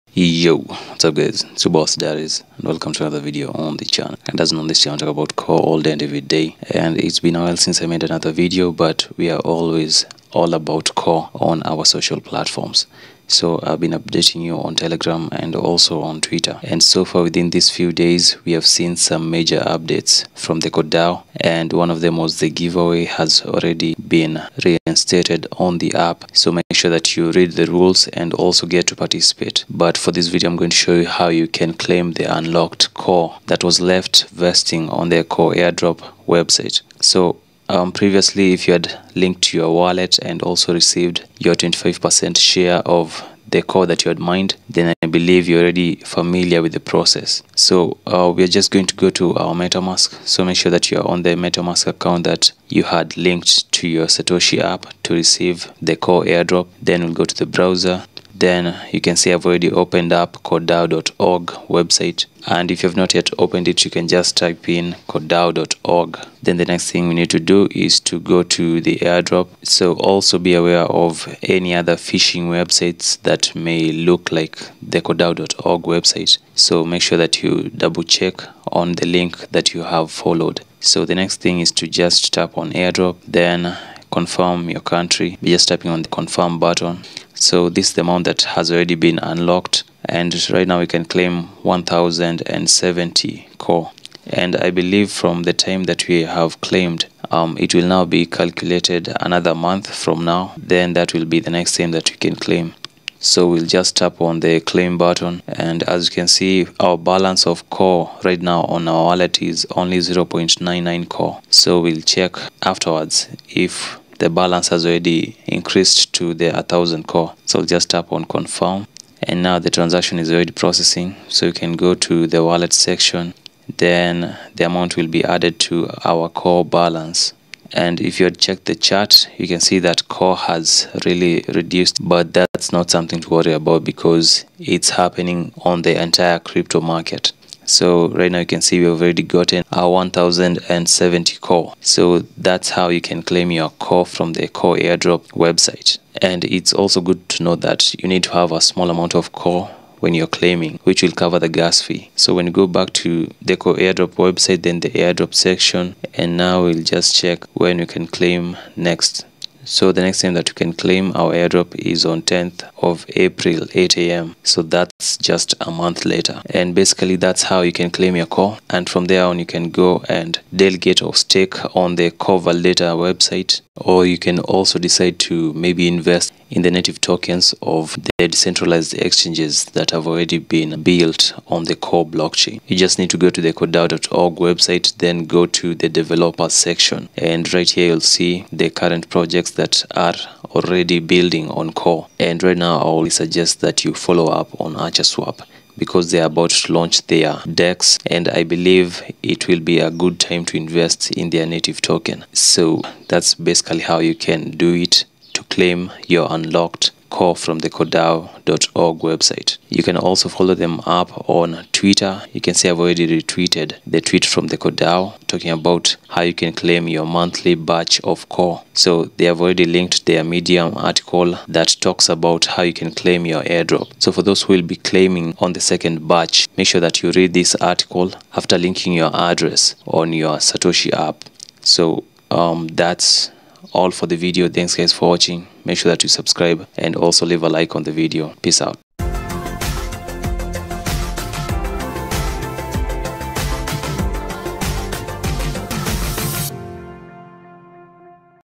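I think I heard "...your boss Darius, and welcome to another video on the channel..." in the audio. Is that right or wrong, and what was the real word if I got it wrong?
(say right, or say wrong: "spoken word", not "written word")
right.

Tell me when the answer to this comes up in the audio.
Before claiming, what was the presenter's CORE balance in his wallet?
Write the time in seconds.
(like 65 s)
109 s.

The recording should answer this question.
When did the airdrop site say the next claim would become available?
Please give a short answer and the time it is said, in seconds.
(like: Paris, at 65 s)
10th of April, at 162 s.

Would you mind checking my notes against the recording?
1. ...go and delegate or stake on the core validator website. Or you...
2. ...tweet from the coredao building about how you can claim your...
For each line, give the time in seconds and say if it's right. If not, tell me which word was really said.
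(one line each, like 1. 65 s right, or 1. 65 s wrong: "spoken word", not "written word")
1. 169 s right
2. 214 s wrong: "talking", not "building".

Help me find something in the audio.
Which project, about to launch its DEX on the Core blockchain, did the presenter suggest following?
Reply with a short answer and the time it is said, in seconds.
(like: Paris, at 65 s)
ArcherSwap, at 194 s.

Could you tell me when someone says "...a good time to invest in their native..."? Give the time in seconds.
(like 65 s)
199 s.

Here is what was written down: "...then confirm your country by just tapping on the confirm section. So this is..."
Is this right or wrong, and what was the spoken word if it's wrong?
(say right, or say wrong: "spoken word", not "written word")
wrong: "button", not "section".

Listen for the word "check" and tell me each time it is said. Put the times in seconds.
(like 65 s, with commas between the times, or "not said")
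78 s, 112 s, 128 s, 157 s.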